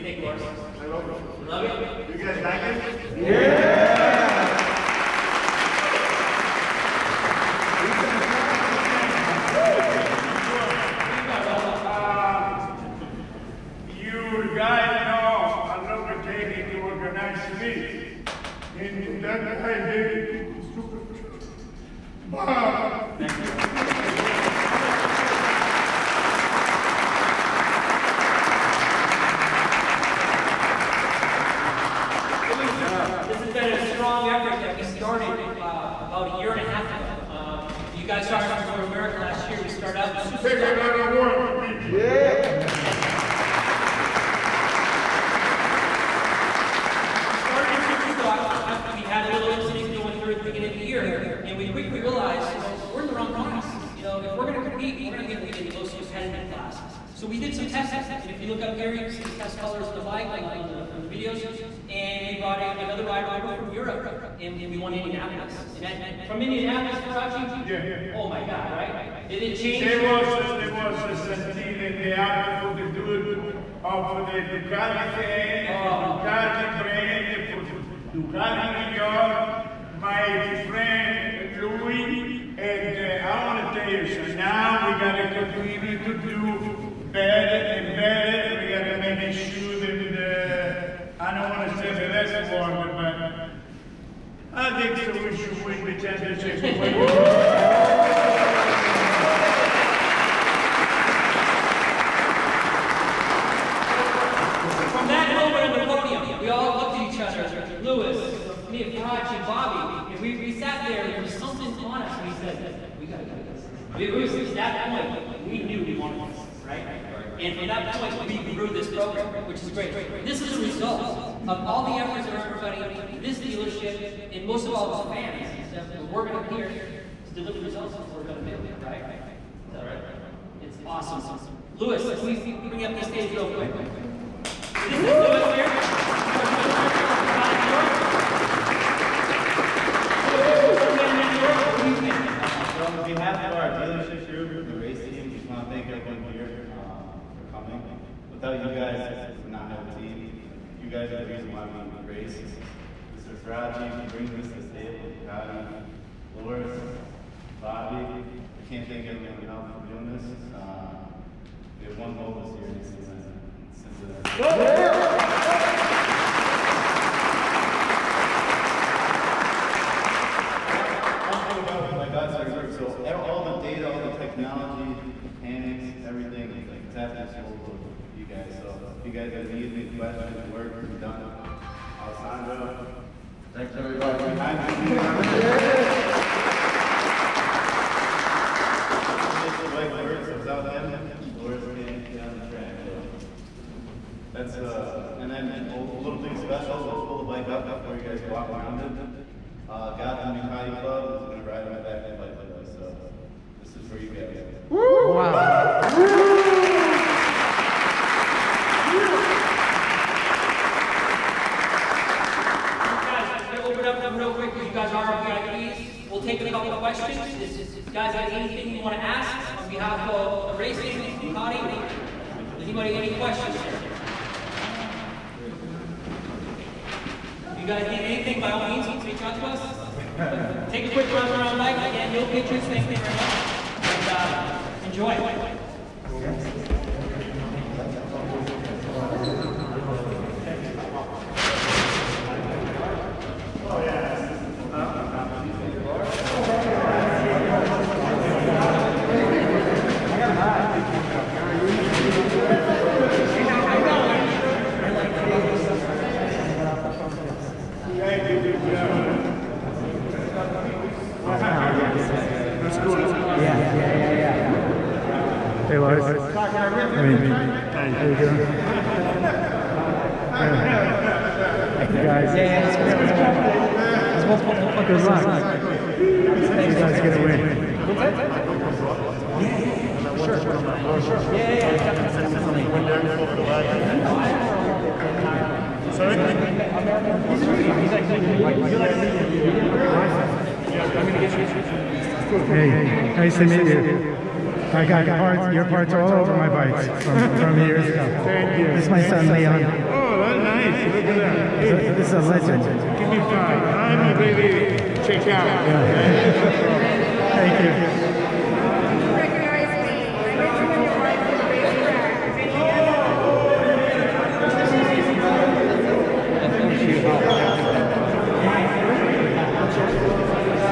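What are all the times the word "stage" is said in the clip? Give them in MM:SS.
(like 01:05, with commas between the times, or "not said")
02:13.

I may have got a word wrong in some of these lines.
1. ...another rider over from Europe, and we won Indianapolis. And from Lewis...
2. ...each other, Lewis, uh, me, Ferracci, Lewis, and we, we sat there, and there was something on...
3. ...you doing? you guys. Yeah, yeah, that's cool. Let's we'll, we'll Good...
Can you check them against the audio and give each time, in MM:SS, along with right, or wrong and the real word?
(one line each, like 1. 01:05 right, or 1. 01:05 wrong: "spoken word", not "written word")
1. 01:02 wrong: "Indianapolis", not "Lewis"
2. 01:47 wrong: "Bobby", not "Lewis"
3. 04:28 right.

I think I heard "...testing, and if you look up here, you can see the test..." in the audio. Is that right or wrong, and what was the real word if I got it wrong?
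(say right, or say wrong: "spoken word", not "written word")
right.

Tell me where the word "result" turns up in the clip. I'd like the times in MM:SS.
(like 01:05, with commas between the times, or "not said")
02:00, 02:07.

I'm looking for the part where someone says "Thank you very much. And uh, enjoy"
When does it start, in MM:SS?
03:52.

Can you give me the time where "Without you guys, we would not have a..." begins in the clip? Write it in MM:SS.
02:28.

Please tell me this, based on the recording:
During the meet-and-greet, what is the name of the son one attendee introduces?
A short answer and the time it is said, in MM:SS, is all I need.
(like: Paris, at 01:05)
Leon, at 04:59.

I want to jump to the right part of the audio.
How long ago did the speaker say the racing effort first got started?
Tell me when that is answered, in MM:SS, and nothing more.
00:36.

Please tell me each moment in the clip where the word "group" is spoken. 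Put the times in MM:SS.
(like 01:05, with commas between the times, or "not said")
02:24, 02:52.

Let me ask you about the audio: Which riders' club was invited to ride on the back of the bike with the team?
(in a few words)
Gotham Ducati Club.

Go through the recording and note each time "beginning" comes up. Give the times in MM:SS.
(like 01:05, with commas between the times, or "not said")
00:50.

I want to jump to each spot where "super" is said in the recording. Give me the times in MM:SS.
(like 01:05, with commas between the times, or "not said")
00:20, 00:40.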